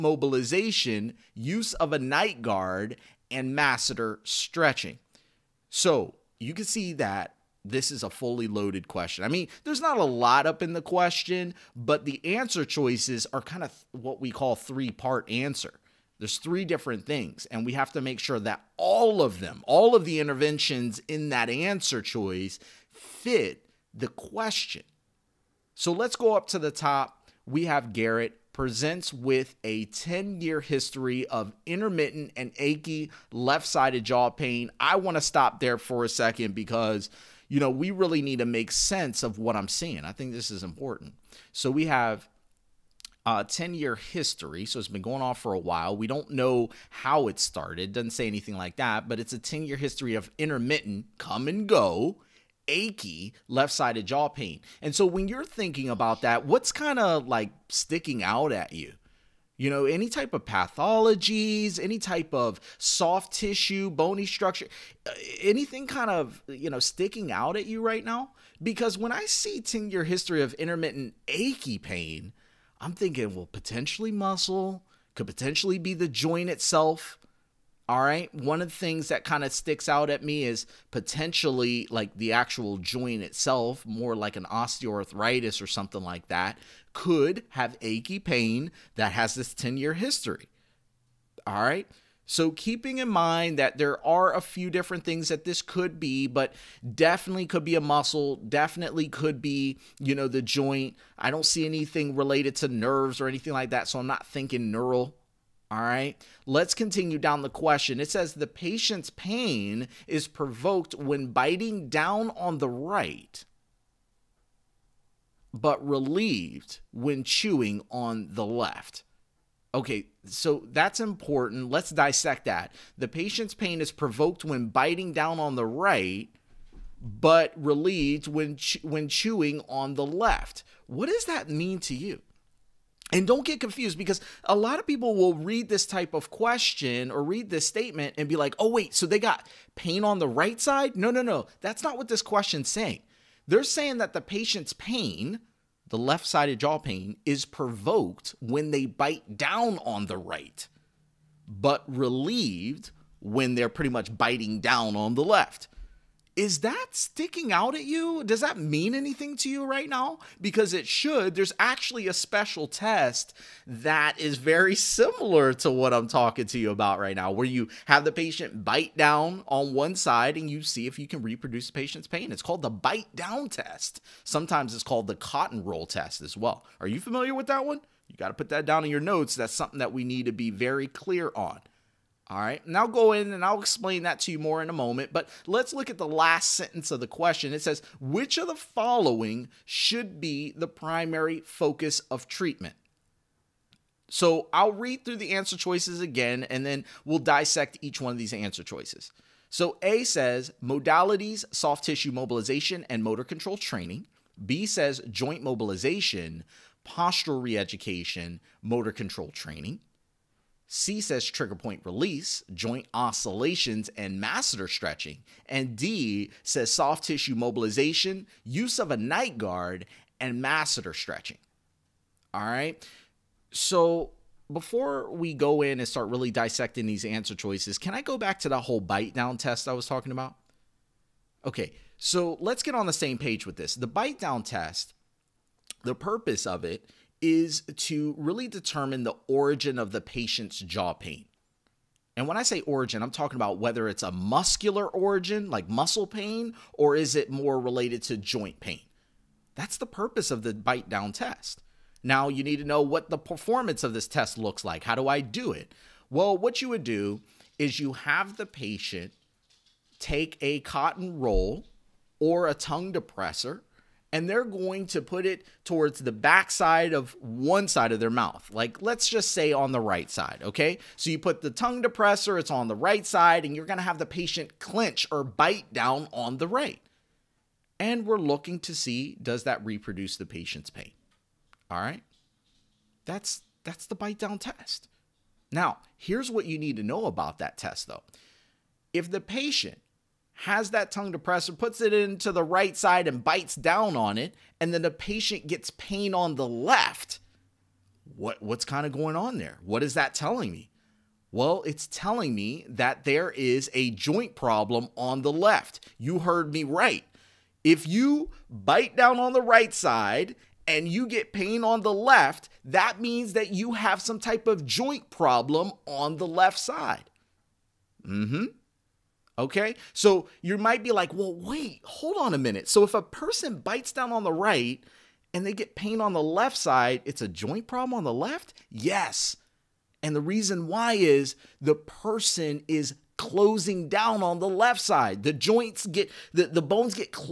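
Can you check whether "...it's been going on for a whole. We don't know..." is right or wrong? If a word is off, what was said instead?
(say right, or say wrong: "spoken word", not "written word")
wrong: "while", not "whole".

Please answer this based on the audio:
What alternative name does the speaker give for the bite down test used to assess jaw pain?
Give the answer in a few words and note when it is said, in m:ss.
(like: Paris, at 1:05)
cotton roll test, at 2:55.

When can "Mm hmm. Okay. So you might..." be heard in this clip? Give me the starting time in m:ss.
5:18.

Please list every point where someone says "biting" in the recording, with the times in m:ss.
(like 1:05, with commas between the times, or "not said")
1:51, 2:04, 2:34.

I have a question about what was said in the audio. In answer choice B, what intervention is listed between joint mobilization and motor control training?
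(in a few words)
postural reeducation.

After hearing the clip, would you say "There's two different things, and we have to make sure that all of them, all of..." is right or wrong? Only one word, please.
wrong.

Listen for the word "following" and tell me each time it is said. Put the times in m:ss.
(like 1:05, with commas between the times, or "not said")
3:08.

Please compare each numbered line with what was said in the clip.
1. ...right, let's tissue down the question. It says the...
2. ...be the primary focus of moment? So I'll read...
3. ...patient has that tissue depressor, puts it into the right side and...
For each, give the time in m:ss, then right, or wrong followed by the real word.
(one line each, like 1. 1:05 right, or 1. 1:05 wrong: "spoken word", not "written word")
1. 1:45 wrong: "continue", not "tissue"
2. 3:10 wrong: "treatment", not "moment"
3. 4:49 wrong: "tongue", not "tissue".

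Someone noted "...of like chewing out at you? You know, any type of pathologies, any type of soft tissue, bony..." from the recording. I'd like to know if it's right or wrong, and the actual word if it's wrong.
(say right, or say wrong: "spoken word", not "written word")
wrong: "sticking", not "chewing".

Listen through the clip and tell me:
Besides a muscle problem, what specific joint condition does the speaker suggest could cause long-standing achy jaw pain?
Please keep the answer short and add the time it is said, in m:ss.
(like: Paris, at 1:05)
osteoarthritis, at 1:24.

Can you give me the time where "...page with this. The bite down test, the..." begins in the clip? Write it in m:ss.
3:53.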